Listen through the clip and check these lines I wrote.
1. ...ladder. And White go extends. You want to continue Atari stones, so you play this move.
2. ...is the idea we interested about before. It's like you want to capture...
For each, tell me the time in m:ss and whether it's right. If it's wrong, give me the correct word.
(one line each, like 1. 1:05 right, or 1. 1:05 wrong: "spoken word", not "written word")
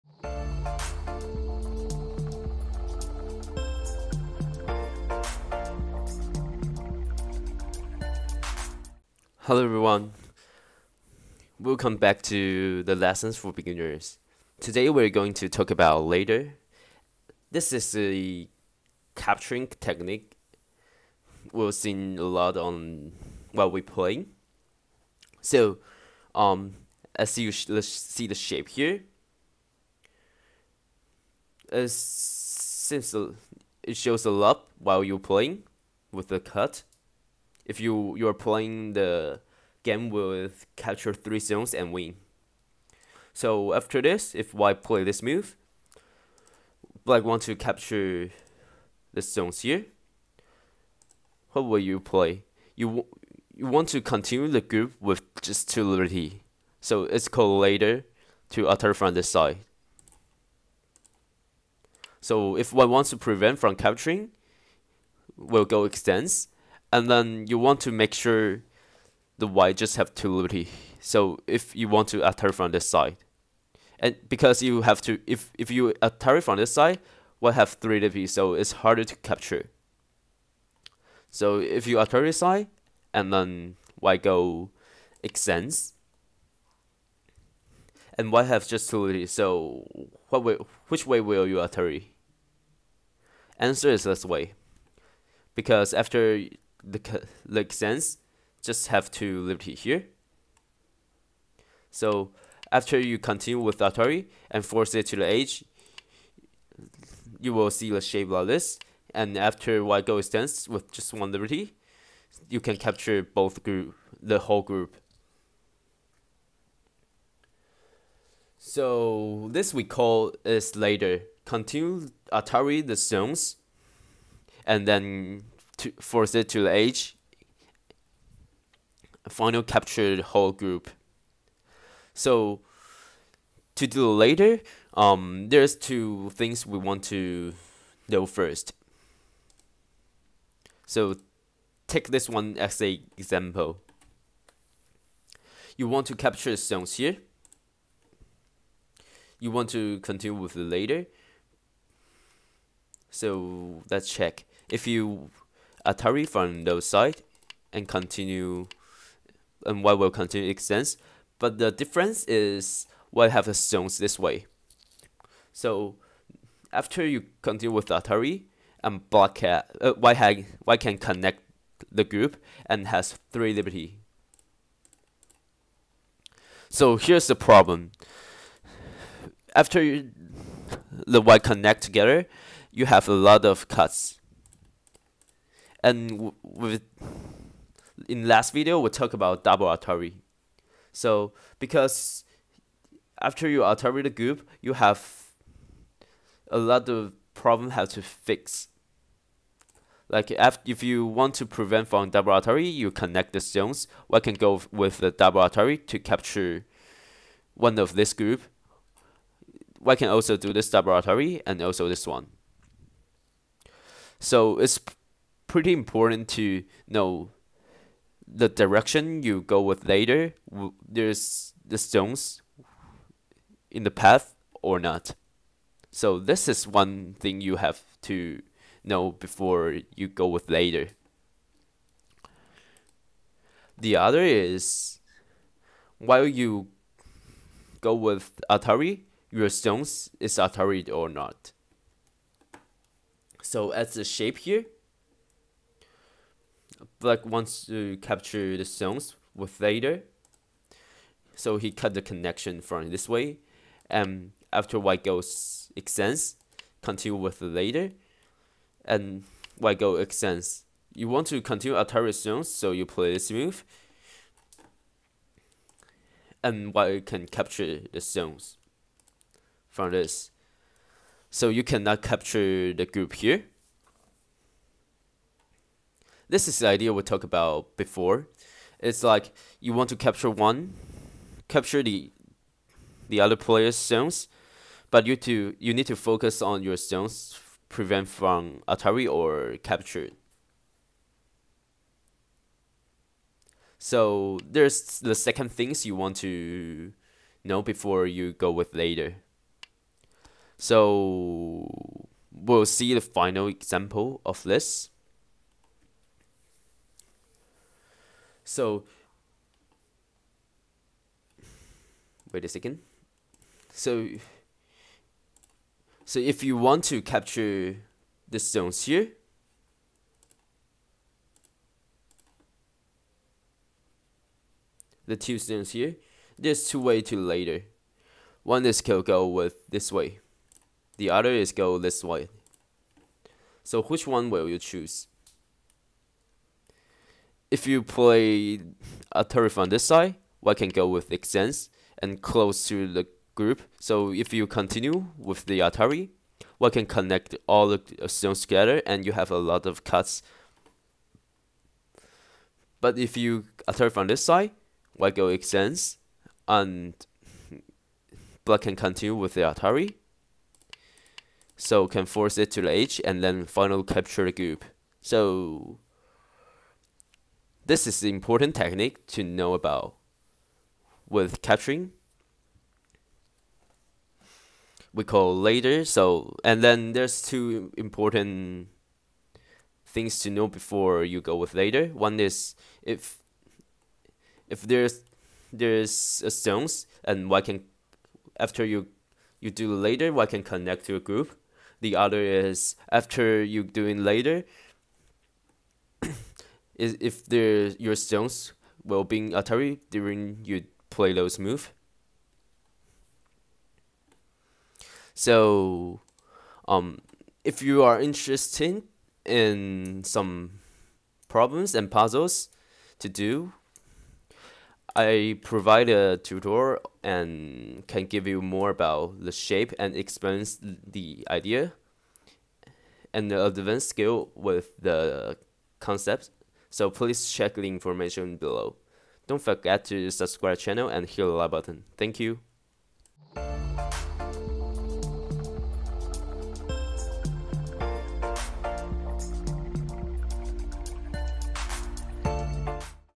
1. 4:17 right
2. 4:36 wrong: "talked", not "interested".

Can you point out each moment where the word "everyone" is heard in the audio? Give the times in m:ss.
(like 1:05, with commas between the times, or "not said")
0:09.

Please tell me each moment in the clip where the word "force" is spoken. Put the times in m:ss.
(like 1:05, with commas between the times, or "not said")
1:44, 2:05, 6:02.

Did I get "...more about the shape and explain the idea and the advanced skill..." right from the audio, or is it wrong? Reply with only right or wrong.
right.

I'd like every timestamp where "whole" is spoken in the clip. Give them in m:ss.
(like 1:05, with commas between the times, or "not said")
1:54, 2:10.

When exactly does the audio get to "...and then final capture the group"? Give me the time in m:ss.
6:03.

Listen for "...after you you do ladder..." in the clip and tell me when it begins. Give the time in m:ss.
6:28.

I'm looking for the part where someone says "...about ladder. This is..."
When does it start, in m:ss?
0:15.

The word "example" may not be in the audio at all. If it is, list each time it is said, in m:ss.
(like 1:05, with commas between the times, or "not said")
2:23, 5:03.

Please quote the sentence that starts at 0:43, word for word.
So after this, if white play this move, black want to capture the zones here.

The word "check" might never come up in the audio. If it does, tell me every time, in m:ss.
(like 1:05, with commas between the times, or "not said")
2:34, 7:07.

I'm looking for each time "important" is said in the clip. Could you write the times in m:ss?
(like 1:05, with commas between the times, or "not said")
3:35, 6:08, 6:17.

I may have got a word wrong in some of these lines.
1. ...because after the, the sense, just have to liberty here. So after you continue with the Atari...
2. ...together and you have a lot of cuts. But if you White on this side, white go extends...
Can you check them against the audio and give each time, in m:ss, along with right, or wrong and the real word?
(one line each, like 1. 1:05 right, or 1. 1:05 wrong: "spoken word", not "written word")
1. 1:35 right
2. 5:48 wrong: "Atari", not "White".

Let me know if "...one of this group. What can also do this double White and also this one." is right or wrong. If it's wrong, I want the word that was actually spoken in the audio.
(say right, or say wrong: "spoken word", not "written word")
wrong: "Atari", not "White".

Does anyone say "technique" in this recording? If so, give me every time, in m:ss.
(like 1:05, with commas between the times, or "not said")
0:19, 6:08.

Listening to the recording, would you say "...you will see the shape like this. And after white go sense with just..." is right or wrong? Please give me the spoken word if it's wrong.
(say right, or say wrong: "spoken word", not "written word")
wrong: "dense", not "sense".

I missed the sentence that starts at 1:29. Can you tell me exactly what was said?
So what way, which way will you attack?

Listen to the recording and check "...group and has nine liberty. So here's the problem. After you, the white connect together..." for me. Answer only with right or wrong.
wrong.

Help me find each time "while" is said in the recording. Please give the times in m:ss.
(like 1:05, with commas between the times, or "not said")
0:23, 0:34, 3:55.